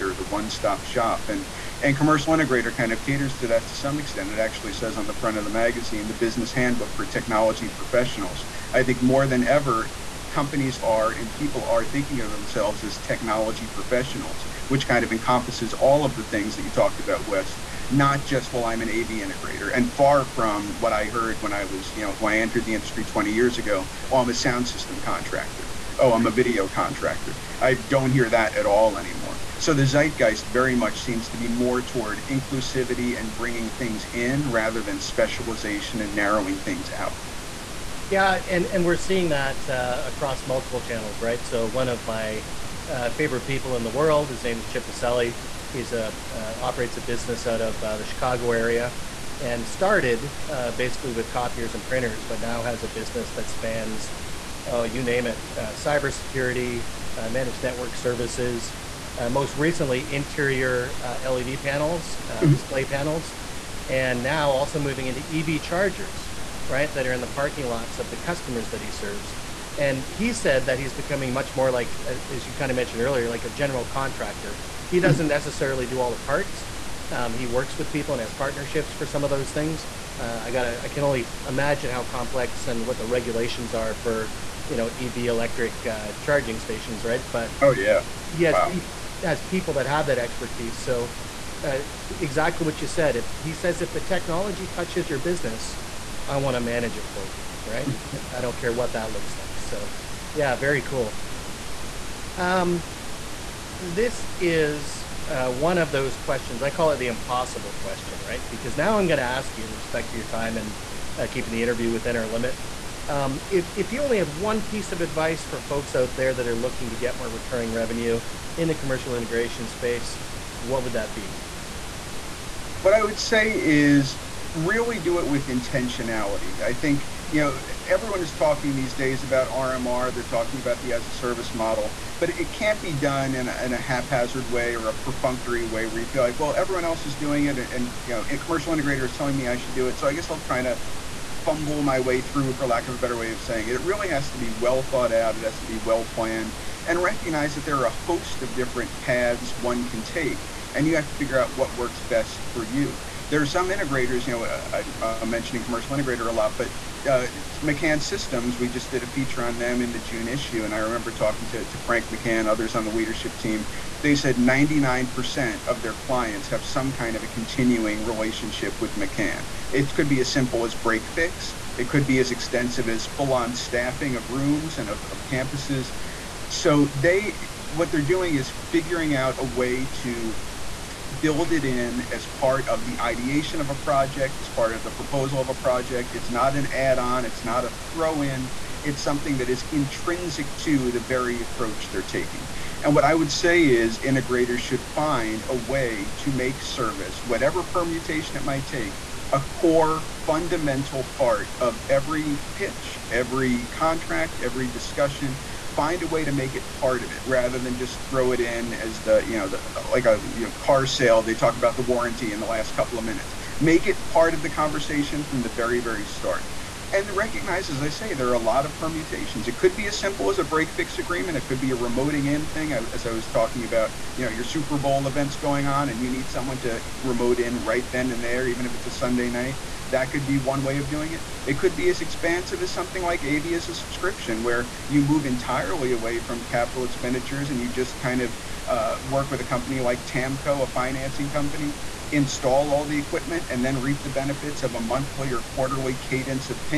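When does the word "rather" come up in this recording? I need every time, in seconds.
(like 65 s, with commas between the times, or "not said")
34 s, 207 s.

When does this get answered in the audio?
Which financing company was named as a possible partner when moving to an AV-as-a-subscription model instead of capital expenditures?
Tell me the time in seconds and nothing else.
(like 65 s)
240 s.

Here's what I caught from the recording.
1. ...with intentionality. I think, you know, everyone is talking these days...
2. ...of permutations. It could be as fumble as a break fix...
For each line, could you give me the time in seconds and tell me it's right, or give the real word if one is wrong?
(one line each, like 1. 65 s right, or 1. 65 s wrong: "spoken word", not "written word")
1. 125 s right
2. 218 s wrong: "simple", not "fumble".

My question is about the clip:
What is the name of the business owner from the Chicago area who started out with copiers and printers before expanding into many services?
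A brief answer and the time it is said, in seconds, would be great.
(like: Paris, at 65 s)
Chip Maselli, at 44 s.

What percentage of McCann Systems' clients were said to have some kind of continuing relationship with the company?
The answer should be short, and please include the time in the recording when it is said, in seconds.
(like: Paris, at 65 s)
99%, at 164 s.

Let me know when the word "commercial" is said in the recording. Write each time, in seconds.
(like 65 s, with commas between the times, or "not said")
1 s, 118 s, 138 s, 155 s.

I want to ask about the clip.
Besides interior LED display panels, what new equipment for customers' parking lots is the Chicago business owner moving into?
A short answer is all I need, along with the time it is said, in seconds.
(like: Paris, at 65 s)
EV chargers, at 65 s.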